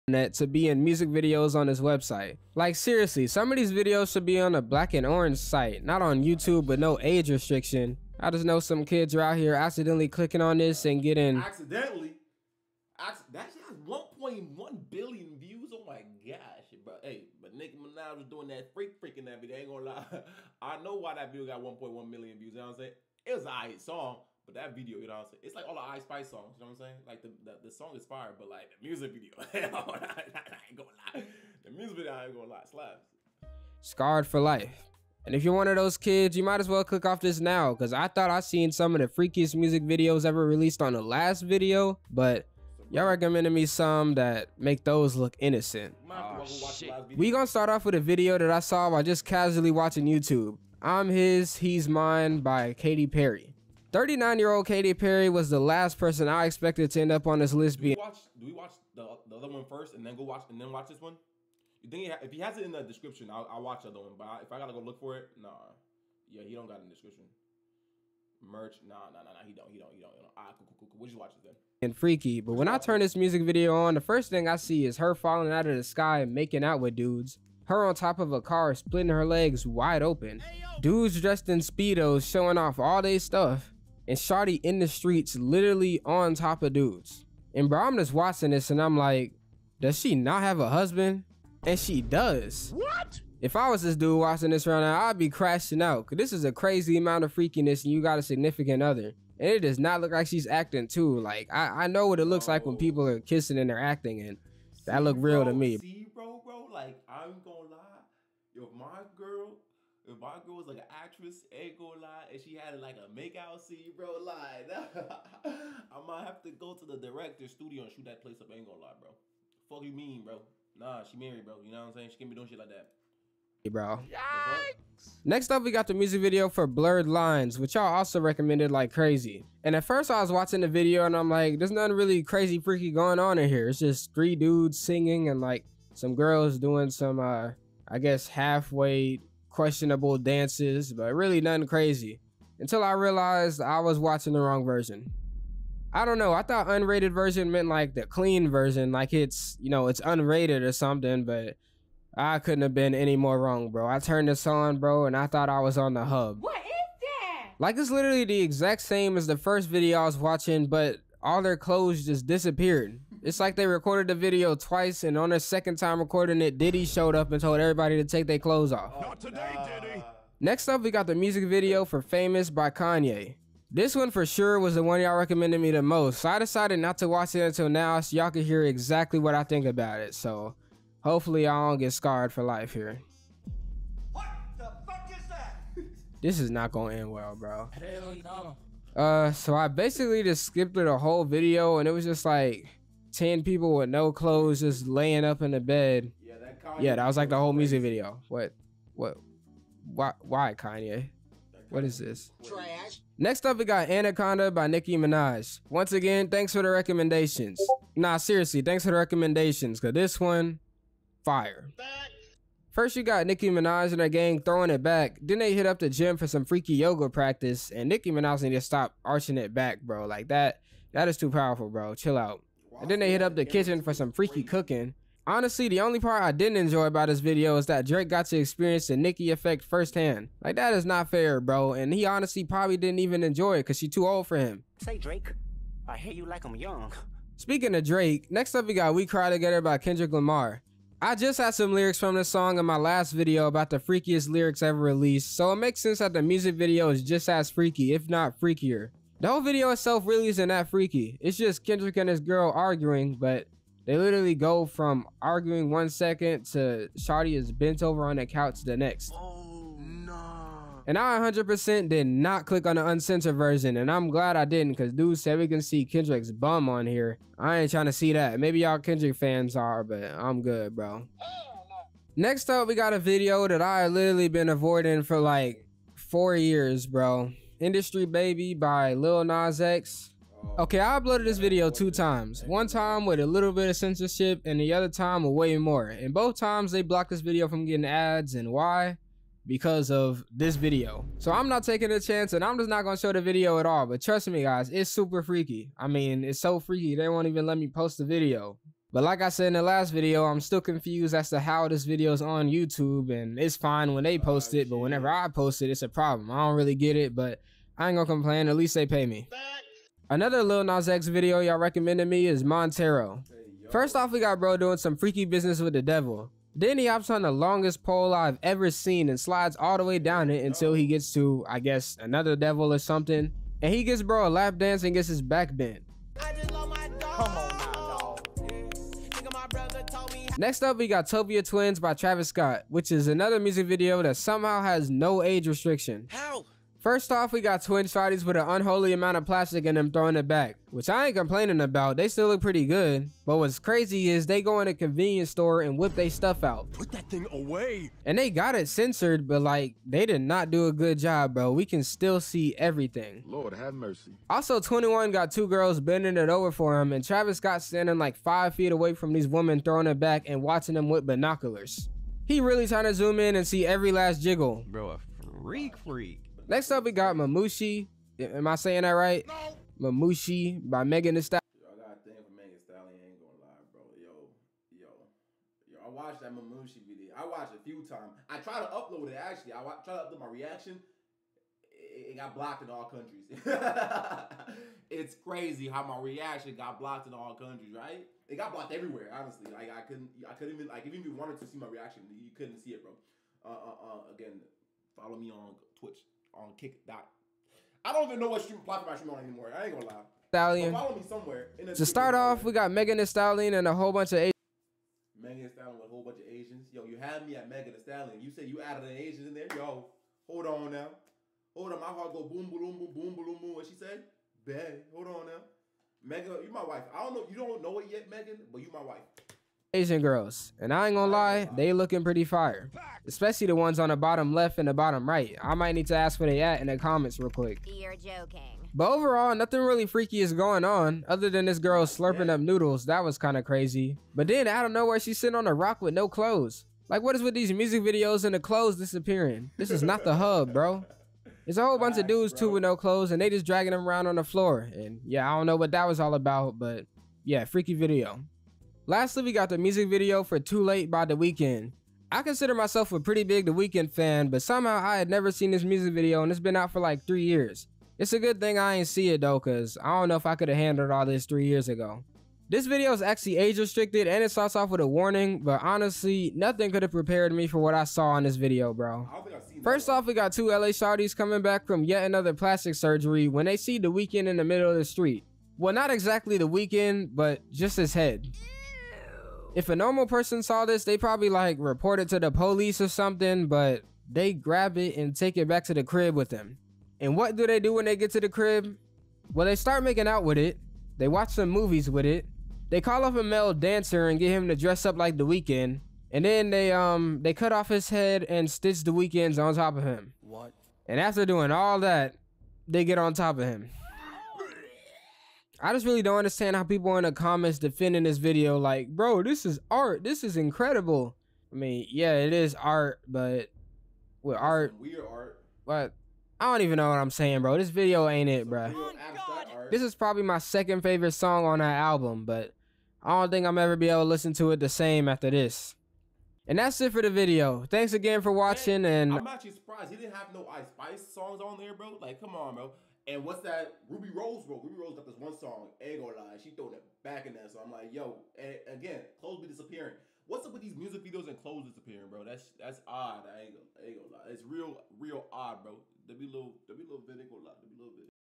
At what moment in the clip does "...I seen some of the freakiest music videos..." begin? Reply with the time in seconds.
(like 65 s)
38 s.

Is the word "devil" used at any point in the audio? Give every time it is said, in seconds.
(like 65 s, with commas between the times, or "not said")
315 s, 322 s.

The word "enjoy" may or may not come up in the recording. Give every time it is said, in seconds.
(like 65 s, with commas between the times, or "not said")
226 s, 233 s.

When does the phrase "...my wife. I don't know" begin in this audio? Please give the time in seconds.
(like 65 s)
416 s.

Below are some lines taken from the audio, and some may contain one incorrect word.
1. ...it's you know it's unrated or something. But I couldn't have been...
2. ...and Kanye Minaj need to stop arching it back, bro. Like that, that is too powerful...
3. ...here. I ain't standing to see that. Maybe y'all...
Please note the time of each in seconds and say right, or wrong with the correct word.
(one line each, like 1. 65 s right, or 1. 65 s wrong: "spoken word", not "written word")
1. 149 s right
2. 217 s wrong: "Nicki", not "Kanye"
3. 266 s wrong: "trying", not "standing".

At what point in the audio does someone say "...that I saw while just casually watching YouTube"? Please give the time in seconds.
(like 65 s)
48 s.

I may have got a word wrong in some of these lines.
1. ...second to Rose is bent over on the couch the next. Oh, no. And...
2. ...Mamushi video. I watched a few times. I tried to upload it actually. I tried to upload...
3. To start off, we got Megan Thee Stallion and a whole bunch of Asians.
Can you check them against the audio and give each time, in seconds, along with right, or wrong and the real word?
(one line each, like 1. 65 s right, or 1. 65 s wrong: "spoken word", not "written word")
1. 255 s wrong: "Shotty", not "Rose"
2. 376 s right
3. 401 s right.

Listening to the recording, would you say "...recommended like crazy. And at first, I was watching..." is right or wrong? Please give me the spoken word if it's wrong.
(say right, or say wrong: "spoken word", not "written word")
right.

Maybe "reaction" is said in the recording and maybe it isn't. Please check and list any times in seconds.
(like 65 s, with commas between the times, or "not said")
380 s, 386 s, 391 s.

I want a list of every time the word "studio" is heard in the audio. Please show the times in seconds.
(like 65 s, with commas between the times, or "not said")
117 s.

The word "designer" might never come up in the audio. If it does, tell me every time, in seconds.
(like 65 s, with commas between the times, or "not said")
not said.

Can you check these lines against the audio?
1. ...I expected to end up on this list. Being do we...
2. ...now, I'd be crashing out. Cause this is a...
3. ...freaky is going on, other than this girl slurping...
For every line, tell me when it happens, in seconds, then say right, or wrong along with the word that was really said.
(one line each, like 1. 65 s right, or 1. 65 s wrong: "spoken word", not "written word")
1. 56 s right
2. 94 s right
3. 429 s right.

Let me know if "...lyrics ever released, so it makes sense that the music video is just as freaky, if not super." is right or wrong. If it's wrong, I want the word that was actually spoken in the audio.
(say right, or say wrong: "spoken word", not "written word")
wrong: "freakier", not "super".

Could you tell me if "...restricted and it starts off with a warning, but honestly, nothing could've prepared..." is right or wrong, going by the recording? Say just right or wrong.
right.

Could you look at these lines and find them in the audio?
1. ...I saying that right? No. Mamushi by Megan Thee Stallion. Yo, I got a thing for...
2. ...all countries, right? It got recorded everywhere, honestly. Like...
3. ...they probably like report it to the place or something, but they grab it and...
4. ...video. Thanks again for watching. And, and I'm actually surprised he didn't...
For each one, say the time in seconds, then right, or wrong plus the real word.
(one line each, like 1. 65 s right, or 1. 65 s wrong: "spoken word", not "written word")
1. 368 s right
2. 387 s wrong: "blocked", not "recorded"
3. 480 s wrong: "police", not "place"
4. 527 s right.